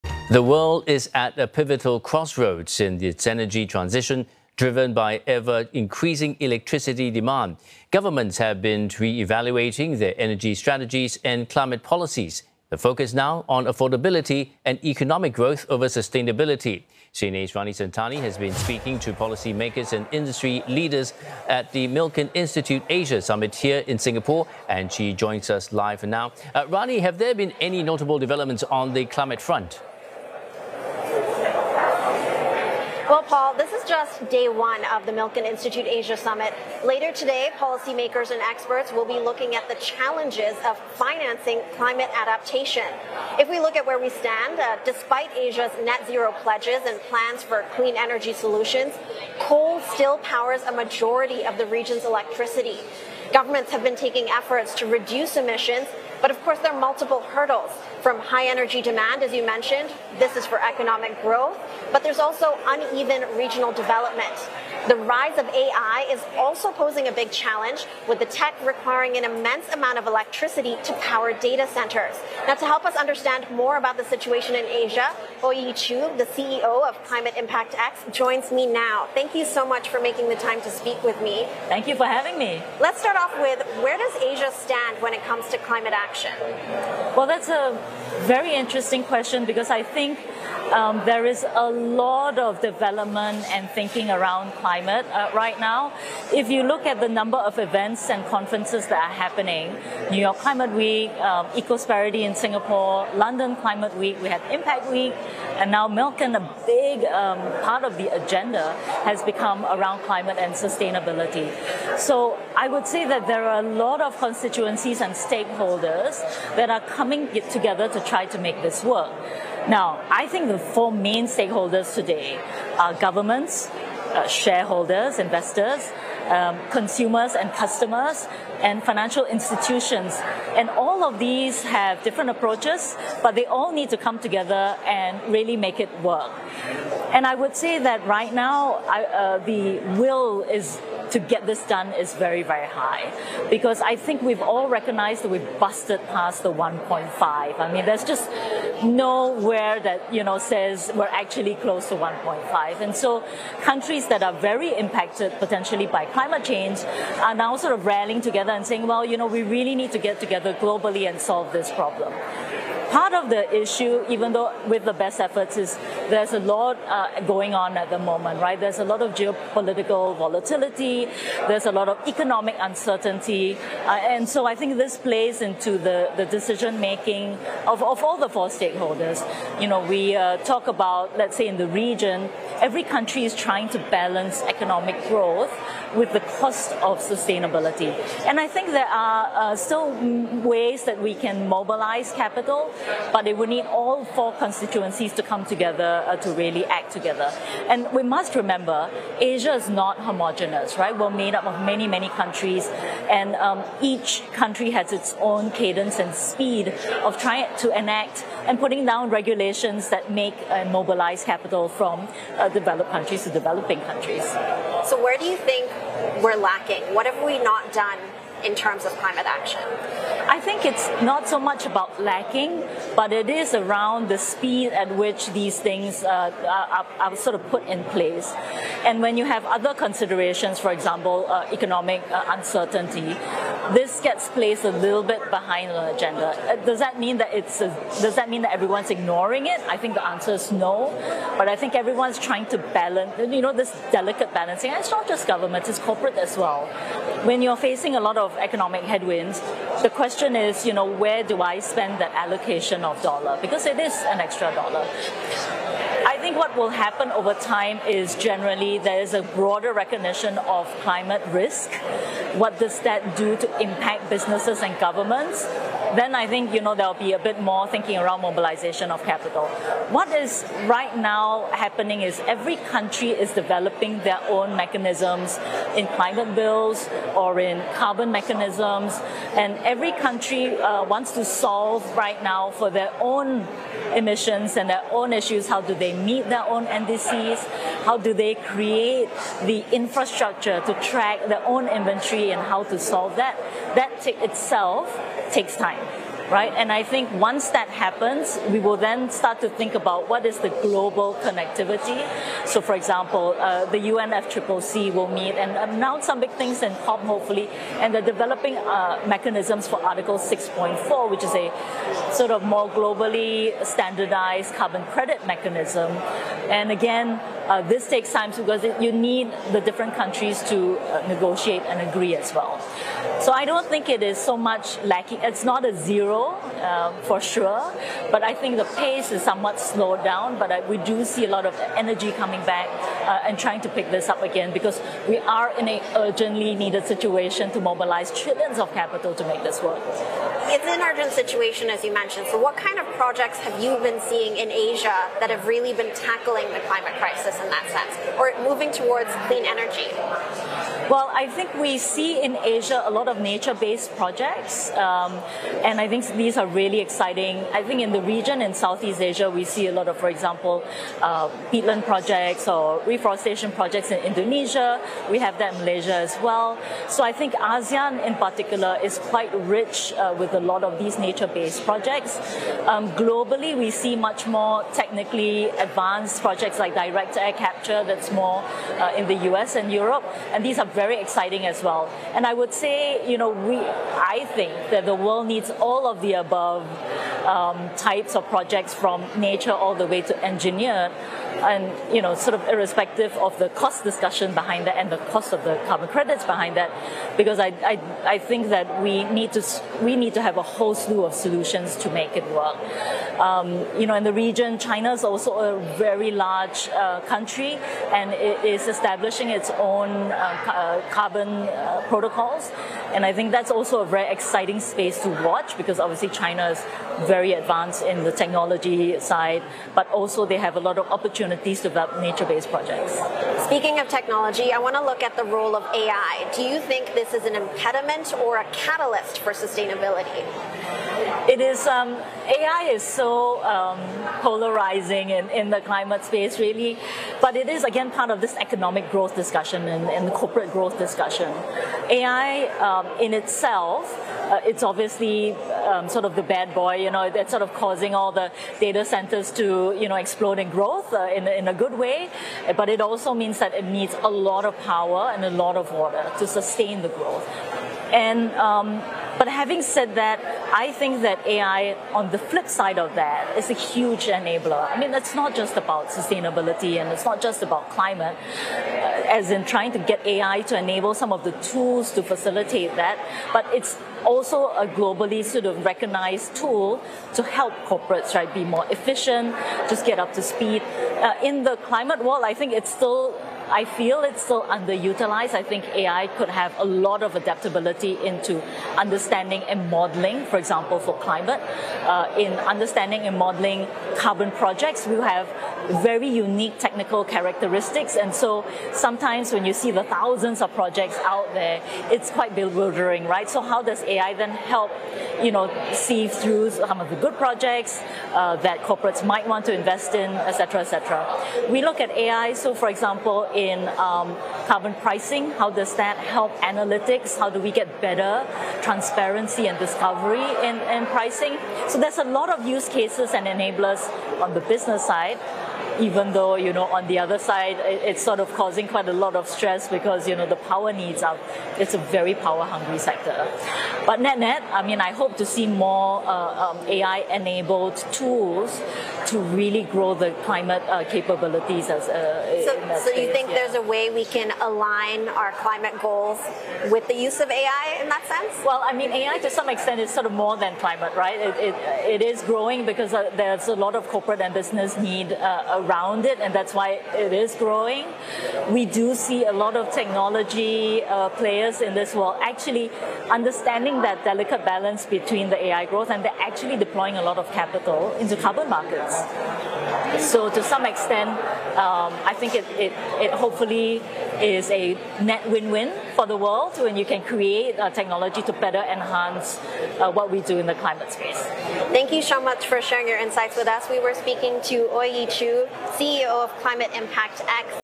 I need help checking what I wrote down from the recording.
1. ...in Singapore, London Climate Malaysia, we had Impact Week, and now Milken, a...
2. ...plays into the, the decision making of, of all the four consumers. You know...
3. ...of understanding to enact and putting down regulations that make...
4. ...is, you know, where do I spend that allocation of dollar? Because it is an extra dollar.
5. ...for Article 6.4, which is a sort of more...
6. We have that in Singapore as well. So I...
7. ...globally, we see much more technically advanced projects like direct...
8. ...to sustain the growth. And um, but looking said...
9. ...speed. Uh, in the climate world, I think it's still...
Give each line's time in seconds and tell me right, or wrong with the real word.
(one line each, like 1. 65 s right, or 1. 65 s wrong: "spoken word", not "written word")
1. 102 s wrong: "Week", not "Malaysia"
2. 174 s wrong: "stakeholders", not "consumers"
3. 207 s wrong: "trying", not "understanding"
4. 250 s right
5. 309 s right
6. 365 s wrong: "Malaysia", not "Singapore"
7. 372 s right
8. 456 s wrong: "having", not "looking"
9. 480 s right.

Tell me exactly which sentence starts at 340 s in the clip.
It's an urgent situation, as you mentioned.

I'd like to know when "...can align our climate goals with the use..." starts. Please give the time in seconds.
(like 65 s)
544 s.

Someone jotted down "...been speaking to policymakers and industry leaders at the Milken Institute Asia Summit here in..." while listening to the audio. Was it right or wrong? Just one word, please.
right.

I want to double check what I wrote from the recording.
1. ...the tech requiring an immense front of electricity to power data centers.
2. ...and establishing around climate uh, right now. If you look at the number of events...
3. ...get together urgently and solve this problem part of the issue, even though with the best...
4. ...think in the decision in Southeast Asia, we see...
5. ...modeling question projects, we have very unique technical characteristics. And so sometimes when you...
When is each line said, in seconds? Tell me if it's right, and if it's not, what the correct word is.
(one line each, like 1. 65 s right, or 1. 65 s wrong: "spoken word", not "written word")
1. 68 s wrong: "amount", not "front"
2. 93 s wrong: "thinking", not "establishing"
3. 159 s wrong: "globally", not "urgently"
4. 357 s wrong: "region", not "decision"
5. 493 s wrong: "carbon", not "question".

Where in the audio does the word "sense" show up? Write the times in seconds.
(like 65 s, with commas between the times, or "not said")
347 s, 548 s.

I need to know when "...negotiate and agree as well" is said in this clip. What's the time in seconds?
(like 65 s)
321 s.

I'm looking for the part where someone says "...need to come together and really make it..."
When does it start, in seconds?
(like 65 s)
133 s.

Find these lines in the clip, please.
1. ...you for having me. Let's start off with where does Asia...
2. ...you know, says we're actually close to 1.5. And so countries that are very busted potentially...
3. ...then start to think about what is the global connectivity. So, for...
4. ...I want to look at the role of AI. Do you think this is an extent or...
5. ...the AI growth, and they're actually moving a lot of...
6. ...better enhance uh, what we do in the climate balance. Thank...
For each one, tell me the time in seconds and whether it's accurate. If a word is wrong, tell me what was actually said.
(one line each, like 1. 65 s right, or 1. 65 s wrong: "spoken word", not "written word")
1. 81 s right
2. 150 s wrong: "impacted", not "busted"
3. 298 s right
4. 424 s wrong: "impediment", not "extent"
5. 565 s wrong: "deploying", not "moving"
6. 578 s wrong: "space", not "balance".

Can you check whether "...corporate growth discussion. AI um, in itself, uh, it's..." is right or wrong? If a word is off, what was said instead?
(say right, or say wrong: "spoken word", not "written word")
right.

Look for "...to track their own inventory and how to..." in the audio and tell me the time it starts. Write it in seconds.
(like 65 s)
290 s.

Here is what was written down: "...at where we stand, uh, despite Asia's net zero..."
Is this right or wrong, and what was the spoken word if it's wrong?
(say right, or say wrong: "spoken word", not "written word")
right.